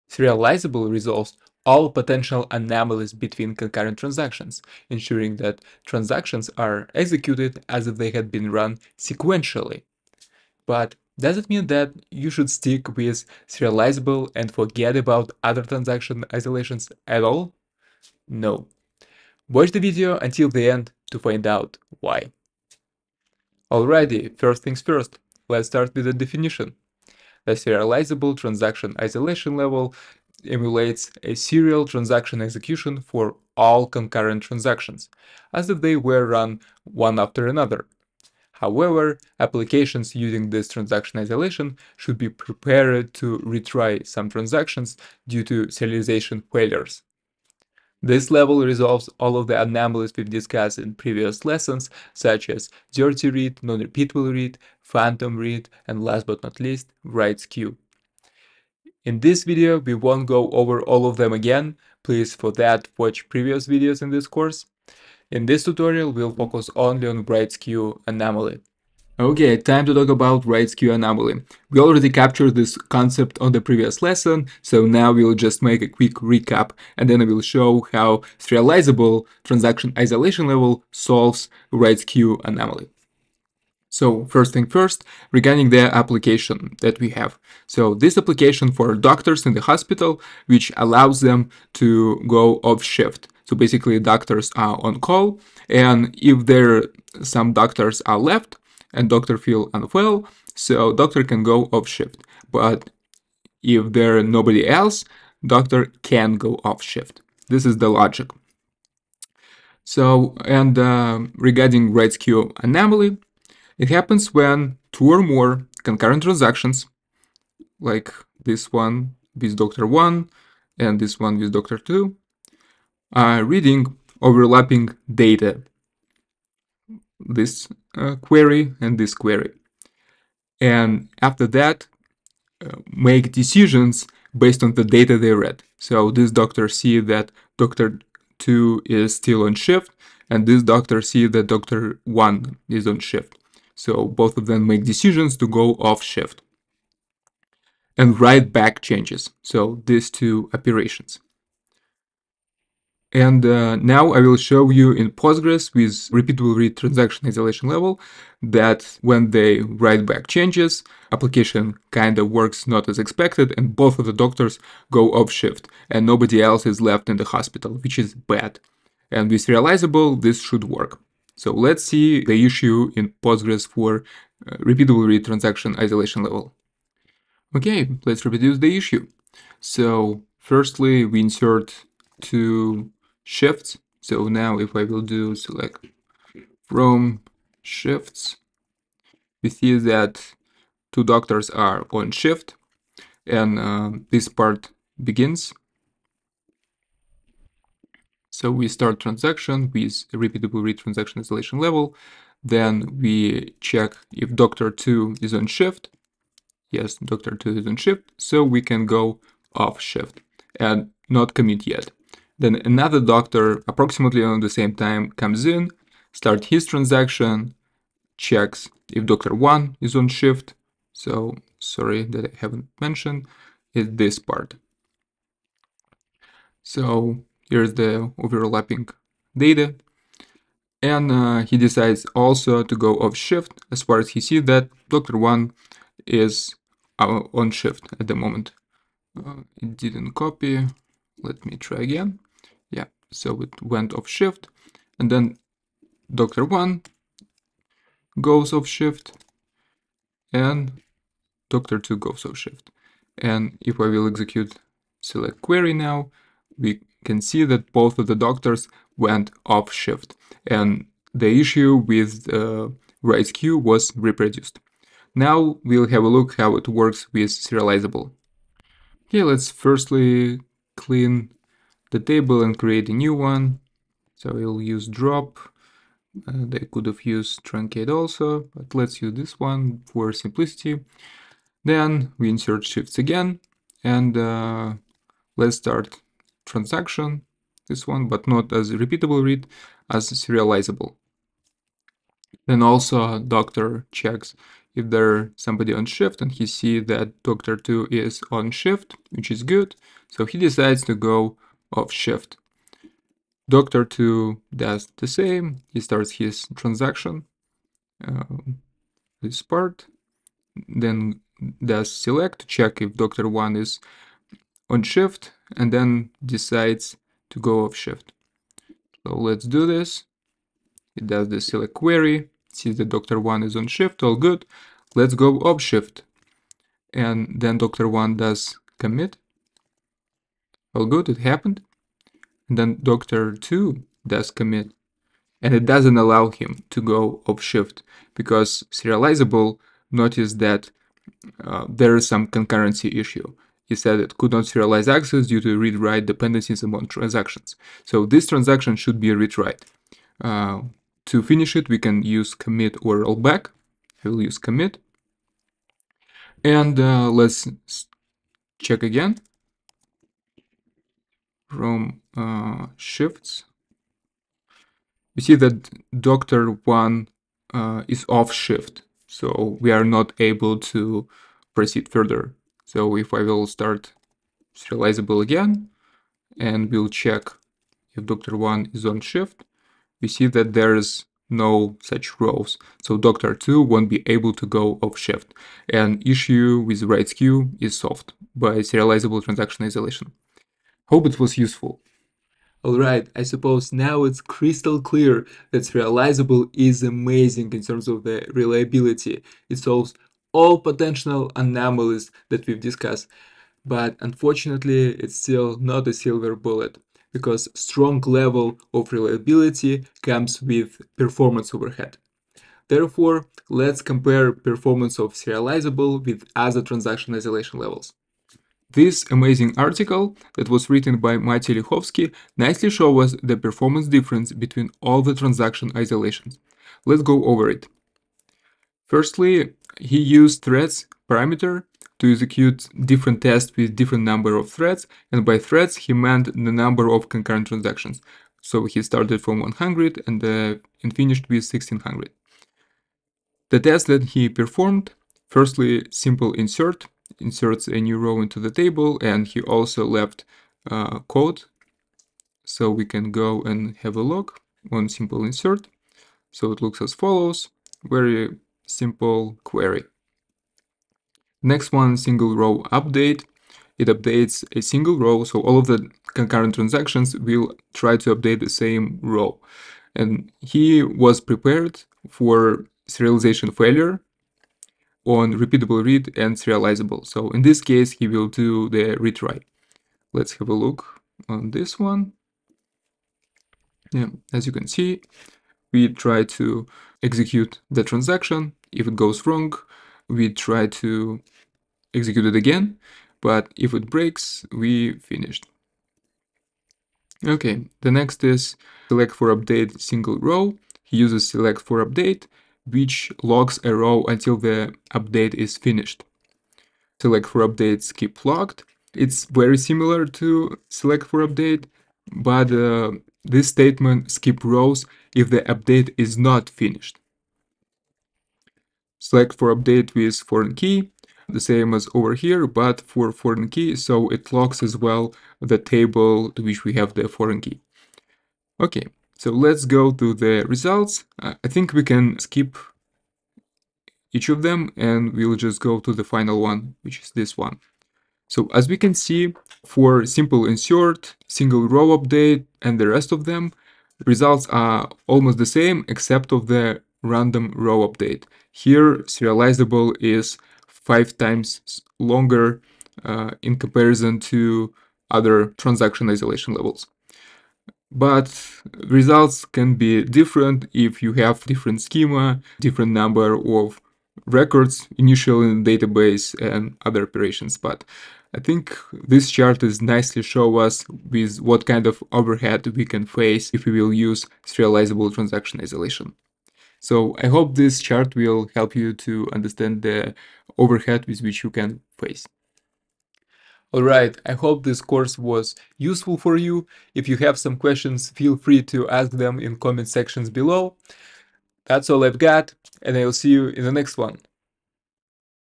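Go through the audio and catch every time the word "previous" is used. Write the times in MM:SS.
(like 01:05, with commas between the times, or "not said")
00:50, 01:03, 01:13.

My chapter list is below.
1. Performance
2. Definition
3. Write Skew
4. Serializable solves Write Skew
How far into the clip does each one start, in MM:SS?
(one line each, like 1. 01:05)
1. 06:32
2. 00:23
3. 01:10
4. 04:29.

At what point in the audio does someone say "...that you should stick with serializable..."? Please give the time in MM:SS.
00:11.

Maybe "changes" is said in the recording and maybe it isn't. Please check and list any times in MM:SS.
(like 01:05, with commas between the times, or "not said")
02:28, 02:40.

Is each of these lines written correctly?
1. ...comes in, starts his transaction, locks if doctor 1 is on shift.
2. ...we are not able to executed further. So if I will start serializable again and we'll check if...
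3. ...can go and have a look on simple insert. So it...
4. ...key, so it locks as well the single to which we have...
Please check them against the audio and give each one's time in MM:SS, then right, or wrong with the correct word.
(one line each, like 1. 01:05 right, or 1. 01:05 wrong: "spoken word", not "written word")
1. 03:35 wrong: "checks", not "locks"
2. 06:09 wrong: "proceed", not "executed"
3. 07:32 right
4. 08:43 wrong: "table", not "single".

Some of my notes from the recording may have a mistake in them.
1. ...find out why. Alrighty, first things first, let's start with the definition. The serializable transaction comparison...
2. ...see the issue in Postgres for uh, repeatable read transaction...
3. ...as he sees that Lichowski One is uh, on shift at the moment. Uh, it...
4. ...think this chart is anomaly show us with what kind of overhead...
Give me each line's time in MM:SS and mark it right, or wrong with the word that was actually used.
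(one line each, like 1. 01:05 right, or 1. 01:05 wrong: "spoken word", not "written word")
1. 00:21 wrong: "isolation", not "comparison"
2. 02:51 right
3. 03:53 wrong: "Doctor", not "Lichowski"
4. 09:28 wrong: "nicely", not "anomaly".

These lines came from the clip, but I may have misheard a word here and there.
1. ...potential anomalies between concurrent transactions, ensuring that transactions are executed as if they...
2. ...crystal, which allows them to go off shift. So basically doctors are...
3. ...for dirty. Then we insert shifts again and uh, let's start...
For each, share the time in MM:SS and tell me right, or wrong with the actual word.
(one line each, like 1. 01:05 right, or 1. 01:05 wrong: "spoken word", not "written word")
1. 00:01 right
2. 01:29 wrong: "hospital", not "crystal"
3. 04:39 wrong: "simplicity", not "dirty".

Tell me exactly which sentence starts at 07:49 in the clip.
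And he was prepared for serialization failure on repeatable read and serializable.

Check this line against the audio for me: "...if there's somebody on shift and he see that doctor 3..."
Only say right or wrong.
wrong.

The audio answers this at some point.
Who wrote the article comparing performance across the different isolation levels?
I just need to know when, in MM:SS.
07:01.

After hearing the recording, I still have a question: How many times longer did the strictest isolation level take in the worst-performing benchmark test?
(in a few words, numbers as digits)
5.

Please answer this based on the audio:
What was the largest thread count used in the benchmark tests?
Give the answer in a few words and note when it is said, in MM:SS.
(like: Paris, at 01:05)
1600, at 07:21.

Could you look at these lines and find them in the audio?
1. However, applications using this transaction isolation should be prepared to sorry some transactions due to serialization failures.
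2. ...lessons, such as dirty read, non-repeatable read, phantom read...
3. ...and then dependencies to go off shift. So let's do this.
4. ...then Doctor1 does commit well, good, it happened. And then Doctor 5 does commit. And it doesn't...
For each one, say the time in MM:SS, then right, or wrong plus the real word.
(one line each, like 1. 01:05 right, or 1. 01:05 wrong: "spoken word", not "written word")
1. 00:38 wrong: "retry", not "sorry"
2. 00:51 right
3. 05:15 wrong: "decides", not "dependencies"
4. 05:27 wrong: "2", not "5".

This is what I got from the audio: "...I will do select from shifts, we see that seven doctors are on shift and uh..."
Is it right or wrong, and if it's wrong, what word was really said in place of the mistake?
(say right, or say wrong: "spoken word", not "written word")
wrong: "two", not "seven".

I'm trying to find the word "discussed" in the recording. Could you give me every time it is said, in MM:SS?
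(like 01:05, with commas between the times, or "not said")
00:50, 06:42.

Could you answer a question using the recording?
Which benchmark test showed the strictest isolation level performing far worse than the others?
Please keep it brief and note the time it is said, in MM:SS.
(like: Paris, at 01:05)
Random row update, at 09:07.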